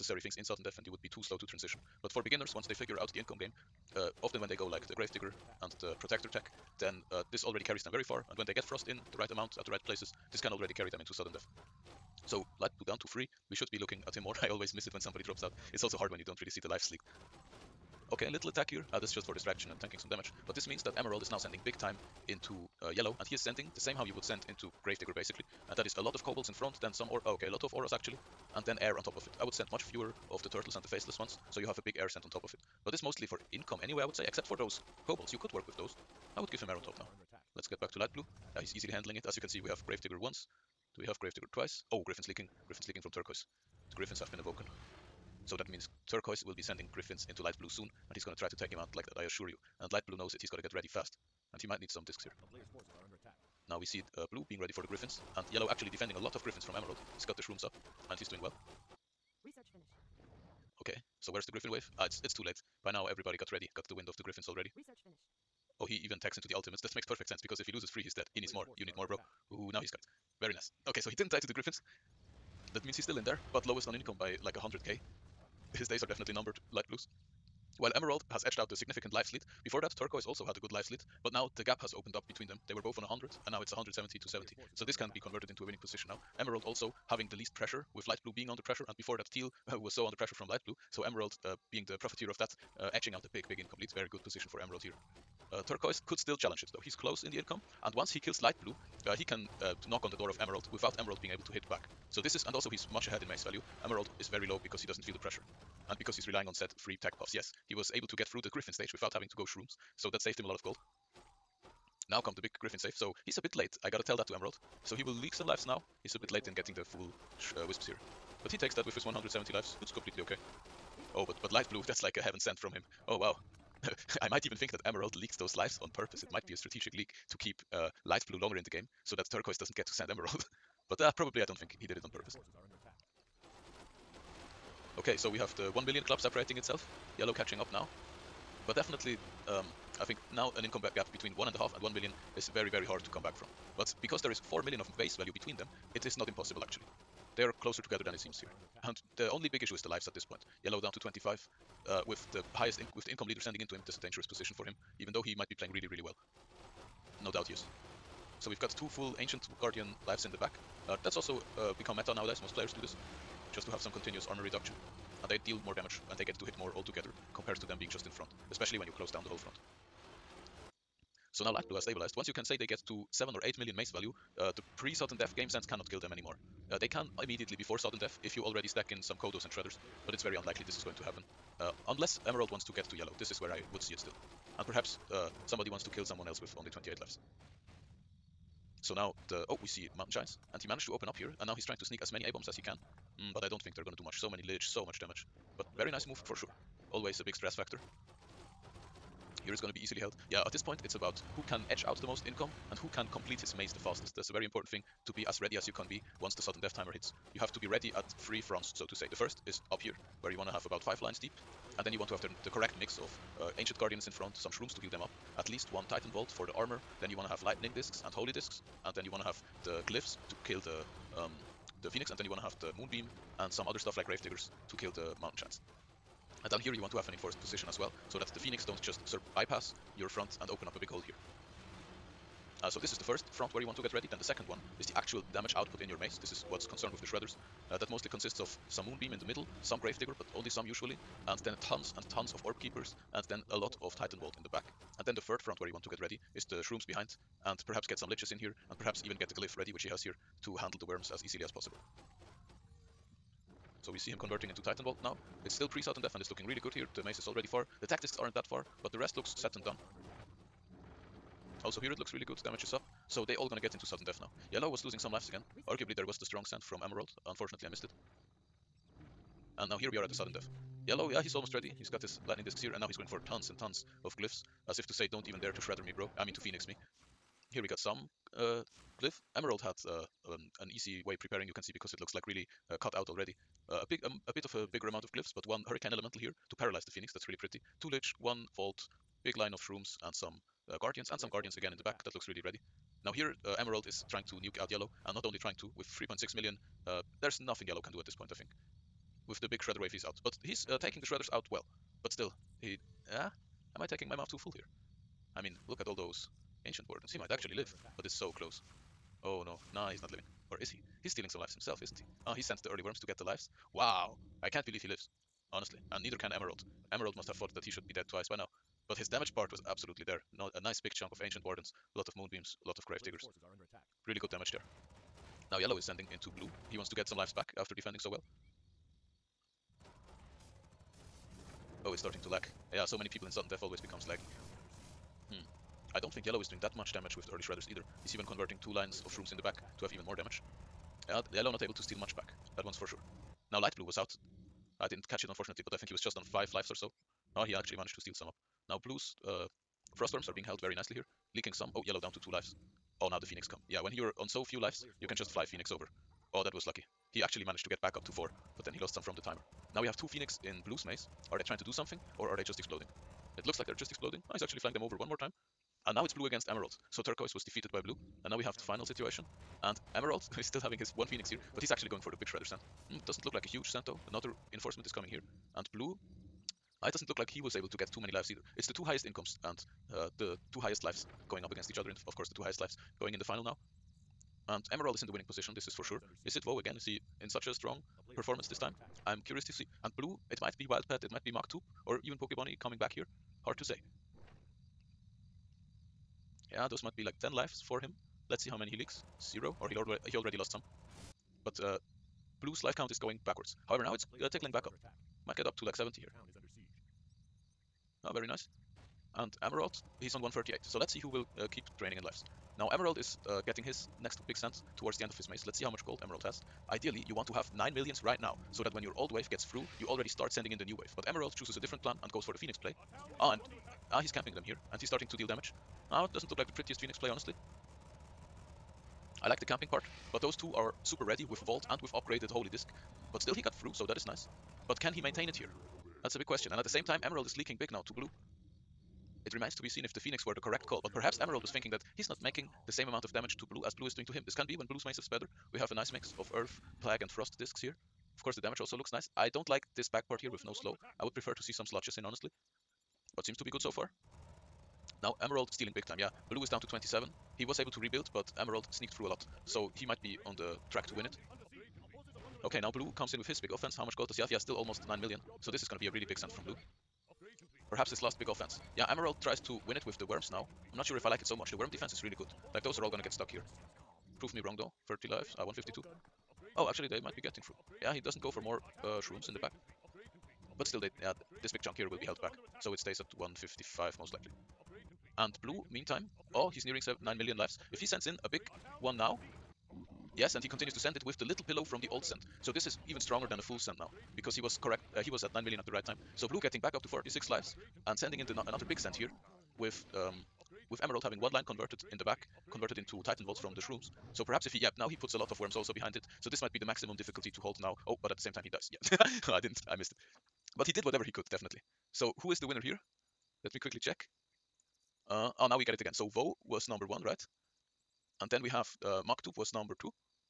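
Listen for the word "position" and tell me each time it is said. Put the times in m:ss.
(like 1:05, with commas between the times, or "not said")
1:25, 1:34, 2:34, 3:47, 6:25.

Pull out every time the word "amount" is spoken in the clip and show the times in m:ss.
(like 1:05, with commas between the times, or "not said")
0:09, 4:44, 7:22.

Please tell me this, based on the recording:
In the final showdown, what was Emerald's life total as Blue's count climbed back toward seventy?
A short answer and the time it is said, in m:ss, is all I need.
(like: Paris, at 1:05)
138, at 6:50.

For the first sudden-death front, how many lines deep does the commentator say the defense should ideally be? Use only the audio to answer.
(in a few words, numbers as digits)
5.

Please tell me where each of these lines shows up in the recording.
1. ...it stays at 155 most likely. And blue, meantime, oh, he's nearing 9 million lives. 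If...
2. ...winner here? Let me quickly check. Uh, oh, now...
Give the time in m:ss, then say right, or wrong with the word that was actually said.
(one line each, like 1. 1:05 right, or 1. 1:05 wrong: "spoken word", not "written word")
1. 8:02 right
2. 8:32 right.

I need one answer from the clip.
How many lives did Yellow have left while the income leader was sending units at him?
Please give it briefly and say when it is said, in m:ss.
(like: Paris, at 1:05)
25, at 2:30.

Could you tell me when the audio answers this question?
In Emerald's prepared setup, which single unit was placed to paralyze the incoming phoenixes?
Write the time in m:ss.
4:45.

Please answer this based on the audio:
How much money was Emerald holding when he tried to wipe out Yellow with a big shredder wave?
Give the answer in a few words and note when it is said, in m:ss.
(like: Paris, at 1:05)
3.6 million, at 4:55.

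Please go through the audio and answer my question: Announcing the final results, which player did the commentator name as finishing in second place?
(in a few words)
Maktub.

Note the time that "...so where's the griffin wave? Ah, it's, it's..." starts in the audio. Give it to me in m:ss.
1:01.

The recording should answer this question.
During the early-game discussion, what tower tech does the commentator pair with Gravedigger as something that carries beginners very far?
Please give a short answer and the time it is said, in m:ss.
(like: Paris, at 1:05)
Protector, at 0:05.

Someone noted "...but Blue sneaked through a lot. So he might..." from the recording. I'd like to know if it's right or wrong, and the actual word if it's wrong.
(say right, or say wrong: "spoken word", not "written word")
wrong: "Emerald", not "Blue".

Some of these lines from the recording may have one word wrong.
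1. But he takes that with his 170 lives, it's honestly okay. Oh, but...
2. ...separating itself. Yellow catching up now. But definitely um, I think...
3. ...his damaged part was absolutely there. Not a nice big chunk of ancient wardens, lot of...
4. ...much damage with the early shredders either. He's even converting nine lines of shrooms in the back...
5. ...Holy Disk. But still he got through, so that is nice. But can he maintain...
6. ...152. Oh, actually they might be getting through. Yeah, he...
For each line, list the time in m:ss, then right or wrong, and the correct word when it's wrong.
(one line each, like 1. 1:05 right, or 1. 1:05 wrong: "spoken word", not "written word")
1. 1:58 wrong: "completely", not "honestly"
2. 2:16 right
3. 5:18 right
4. 5:36 wrong: "two", not "nine"
5. 7:12 right
6. 7:55 right.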